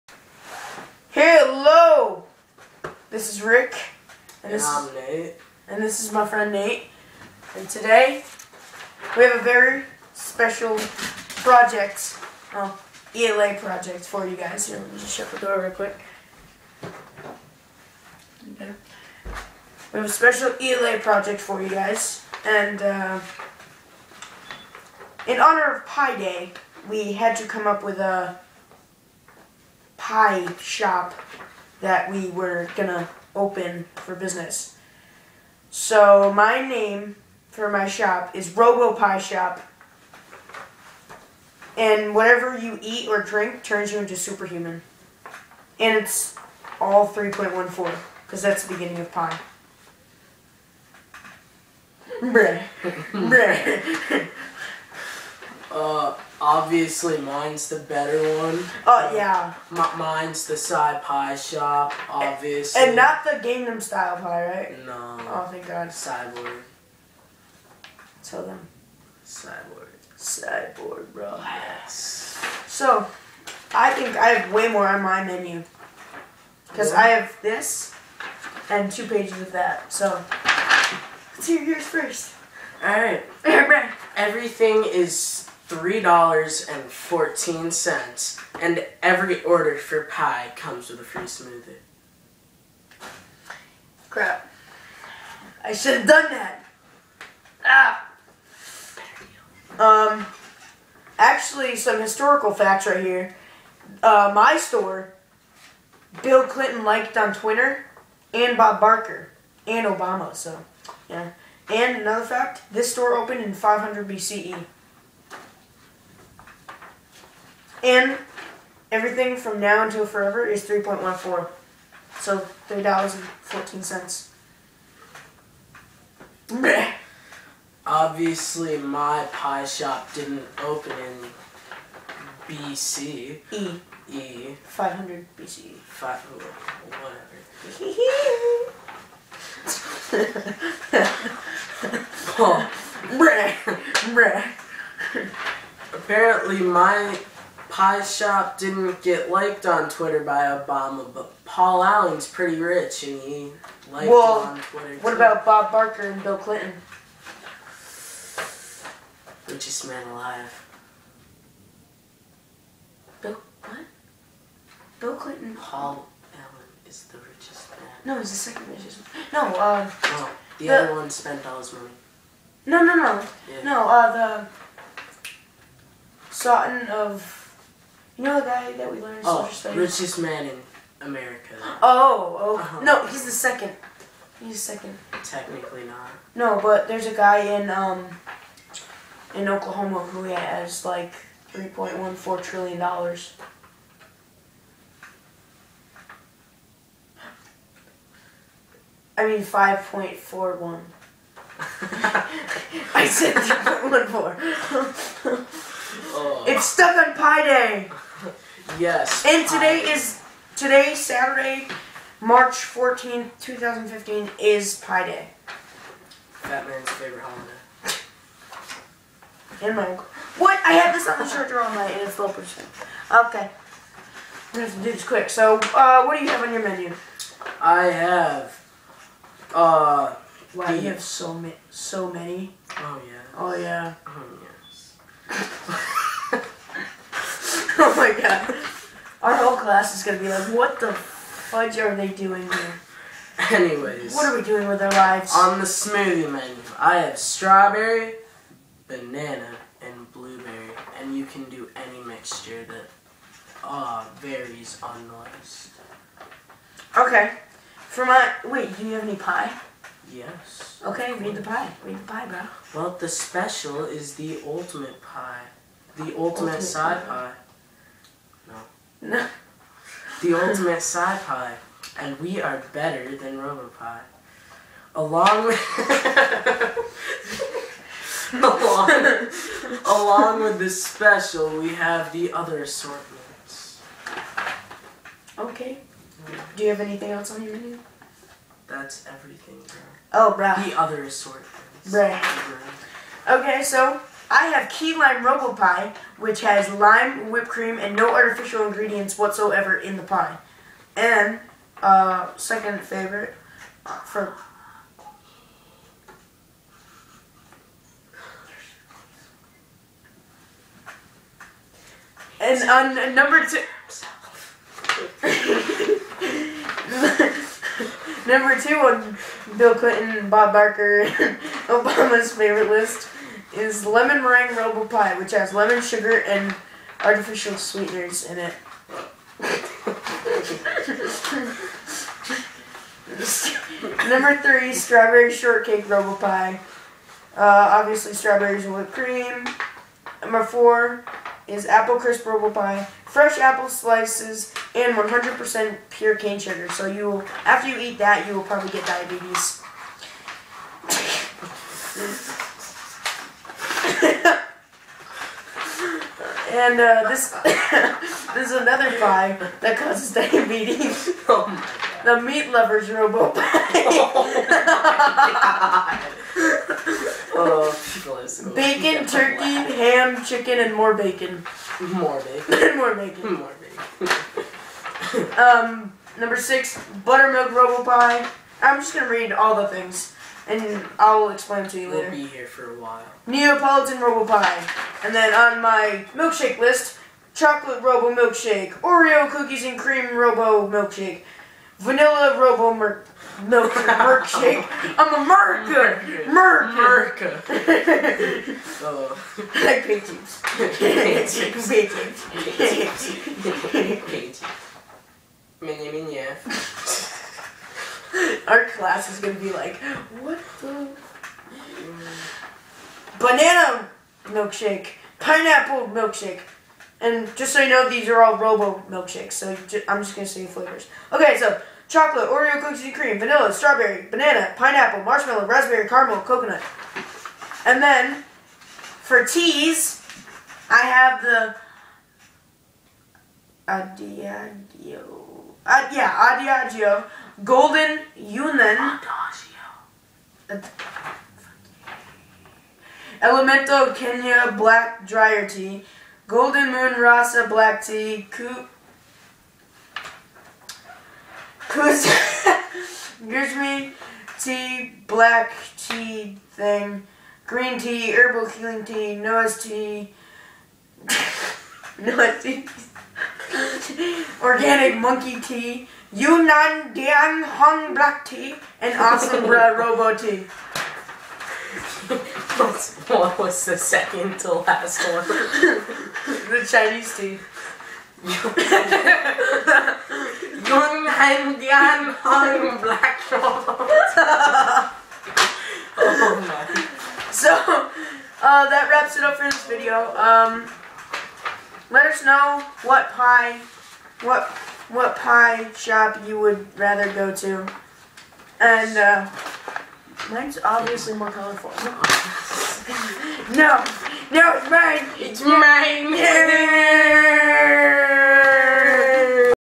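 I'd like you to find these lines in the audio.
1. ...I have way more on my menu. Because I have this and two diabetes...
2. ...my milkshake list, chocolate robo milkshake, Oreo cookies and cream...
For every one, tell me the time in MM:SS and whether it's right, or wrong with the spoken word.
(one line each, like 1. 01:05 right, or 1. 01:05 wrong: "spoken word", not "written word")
1. 01:14 wrong: "pages", not "diabetes"
2. 06:25 right.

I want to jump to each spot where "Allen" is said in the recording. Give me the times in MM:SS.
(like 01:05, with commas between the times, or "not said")
02:31, 02:46.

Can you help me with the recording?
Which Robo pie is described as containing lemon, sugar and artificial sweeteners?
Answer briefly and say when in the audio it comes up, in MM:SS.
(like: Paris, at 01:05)
lemon meringue robo pie, at 05:23.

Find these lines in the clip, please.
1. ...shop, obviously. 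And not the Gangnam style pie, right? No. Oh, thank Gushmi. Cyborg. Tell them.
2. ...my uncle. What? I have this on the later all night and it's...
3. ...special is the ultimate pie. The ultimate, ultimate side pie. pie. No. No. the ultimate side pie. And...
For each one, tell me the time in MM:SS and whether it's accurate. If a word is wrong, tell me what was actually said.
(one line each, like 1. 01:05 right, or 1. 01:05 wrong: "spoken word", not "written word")
1. 01:01 wrong: "God", not "Gushmi"
2. 03:39 wrong: "charger", not "later"
3. 04:23 right.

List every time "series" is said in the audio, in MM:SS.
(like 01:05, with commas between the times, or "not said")
not said.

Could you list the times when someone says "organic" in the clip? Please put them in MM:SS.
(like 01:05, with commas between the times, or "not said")
07:44.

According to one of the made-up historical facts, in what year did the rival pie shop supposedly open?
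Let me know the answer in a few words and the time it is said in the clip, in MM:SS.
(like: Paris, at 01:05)
500 BCE, at 01:53.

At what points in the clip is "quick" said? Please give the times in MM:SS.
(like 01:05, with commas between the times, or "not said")
00:15, 03:45.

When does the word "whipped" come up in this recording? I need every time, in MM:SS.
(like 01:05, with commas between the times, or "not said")
04:57, 05:38.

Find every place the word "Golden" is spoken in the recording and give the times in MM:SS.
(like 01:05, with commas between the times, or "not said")
07:17, 07:26.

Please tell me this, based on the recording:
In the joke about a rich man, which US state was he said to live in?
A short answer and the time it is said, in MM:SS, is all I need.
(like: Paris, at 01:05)
Oklahoma, at 03:09.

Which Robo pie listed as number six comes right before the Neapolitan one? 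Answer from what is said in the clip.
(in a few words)
buttermilk robo pie.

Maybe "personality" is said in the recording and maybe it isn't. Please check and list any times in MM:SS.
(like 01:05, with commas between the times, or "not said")
not said.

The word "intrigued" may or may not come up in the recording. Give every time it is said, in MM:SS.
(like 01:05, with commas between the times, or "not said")
not said.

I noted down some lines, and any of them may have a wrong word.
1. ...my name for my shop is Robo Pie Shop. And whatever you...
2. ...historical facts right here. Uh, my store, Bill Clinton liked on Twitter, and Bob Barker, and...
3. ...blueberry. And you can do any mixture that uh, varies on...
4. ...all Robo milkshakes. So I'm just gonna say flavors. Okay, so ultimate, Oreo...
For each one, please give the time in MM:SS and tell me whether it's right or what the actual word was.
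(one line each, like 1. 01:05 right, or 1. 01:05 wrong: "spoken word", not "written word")
1. 00:36 right
2. 01:42 right
3. 04:10 right
4. 06:58 wrong: "chocolate", not "ultimate".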